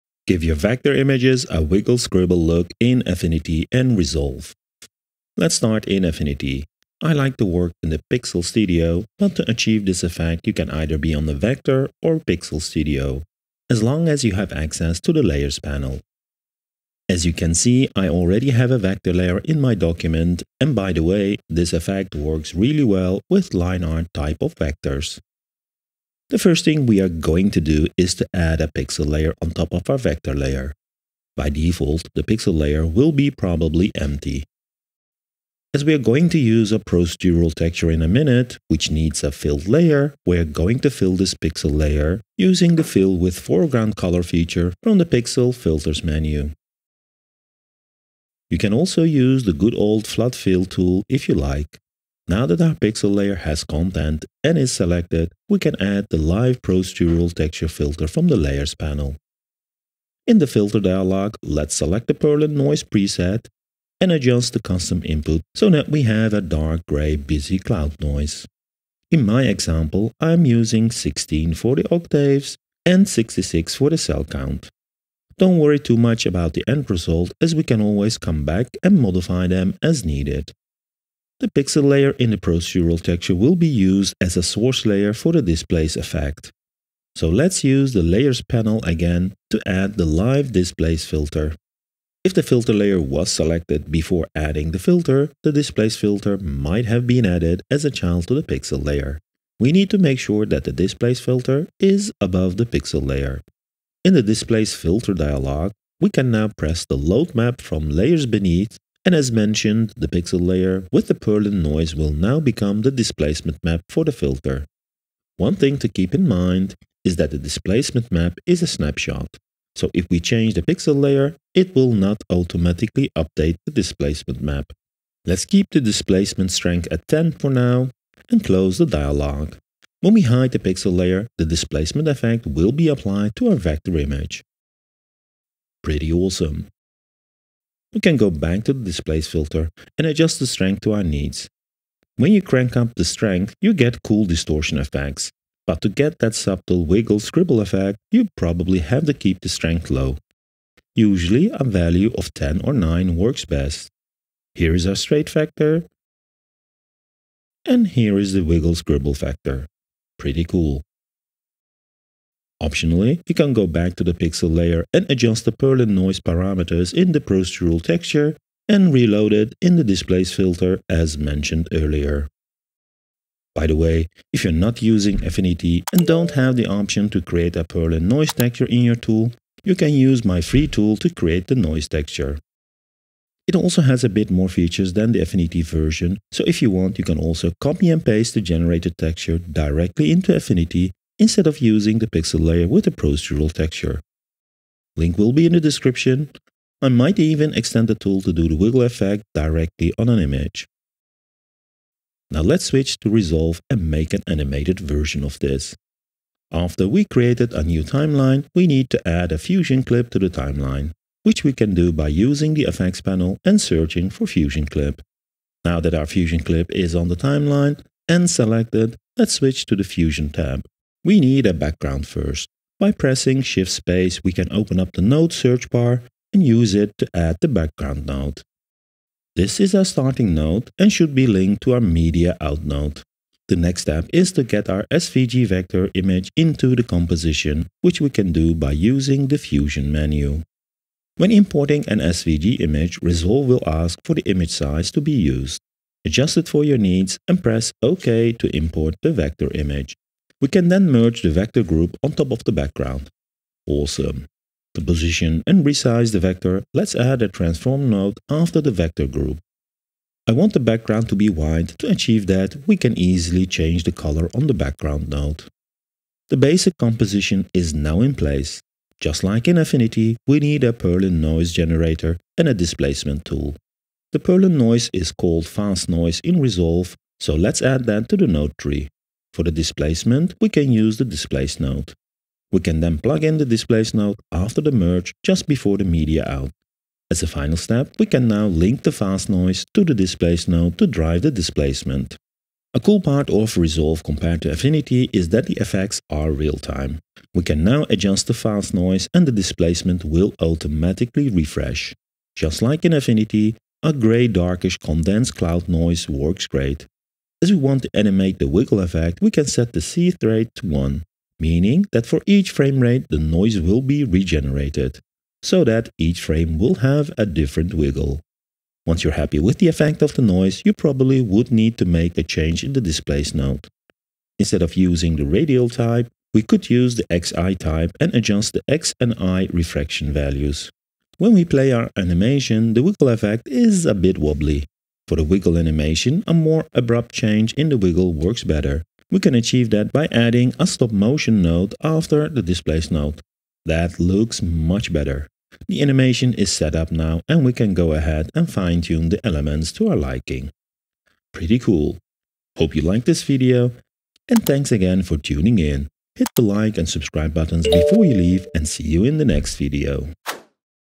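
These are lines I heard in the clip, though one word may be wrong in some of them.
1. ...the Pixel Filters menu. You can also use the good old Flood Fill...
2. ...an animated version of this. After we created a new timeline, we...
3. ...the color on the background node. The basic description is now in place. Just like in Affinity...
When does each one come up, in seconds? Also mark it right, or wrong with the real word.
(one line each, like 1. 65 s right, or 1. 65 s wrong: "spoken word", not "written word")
1. 44 s right
2. 204 s right
3. 263 s wrong: "composition", not "description".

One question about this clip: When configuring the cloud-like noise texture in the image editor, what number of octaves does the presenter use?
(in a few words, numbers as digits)
16.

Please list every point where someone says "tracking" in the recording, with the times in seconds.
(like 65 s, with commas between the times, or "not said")
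not said.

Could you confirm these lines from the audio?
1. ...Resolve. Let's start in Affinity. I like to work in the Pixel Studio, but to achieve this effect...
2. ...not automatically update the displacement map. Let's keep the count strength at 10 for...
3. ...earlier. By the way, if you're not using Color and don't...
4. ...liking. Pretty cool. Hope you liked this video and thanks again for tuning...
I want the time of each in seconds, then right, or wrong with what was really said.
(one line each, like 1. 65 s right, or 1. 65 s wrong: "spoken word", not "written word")
1. 3 s right
2. 121 s wrong: "displacement", not "count"
3. 171 s wrong: "Affinity", not "Color"
4. 349 s right.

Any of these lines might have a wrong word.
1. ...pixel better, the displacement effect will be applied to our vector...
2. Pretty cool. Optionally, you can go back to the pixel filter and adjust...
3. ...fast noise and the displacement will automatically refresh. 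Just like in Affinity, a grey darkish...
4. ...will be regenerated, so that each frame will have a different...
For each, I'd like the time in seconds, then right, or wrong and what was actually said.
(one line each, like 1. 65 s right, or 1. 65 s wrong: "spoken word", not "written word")
1. 130 s wrong: "layer", not "better"
2. 160 s wrong: "layer", not "filter"
3. 298 s right
4. 313 s right.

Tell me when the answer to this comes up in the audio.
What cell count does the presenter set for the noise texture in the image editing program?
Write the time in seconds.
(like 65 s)
73 s.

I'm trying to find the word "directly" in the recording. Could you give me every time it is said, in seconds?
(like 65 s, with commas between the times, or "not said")
189 s, 199 s.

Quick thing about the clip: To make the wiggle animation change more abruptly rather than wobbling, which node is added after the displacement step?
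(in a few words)
stop motion node.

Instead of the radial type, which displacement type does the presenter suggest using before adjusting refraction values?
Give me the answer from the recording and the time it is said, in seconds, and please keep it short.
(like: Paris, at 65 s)
XY type, at 327 s.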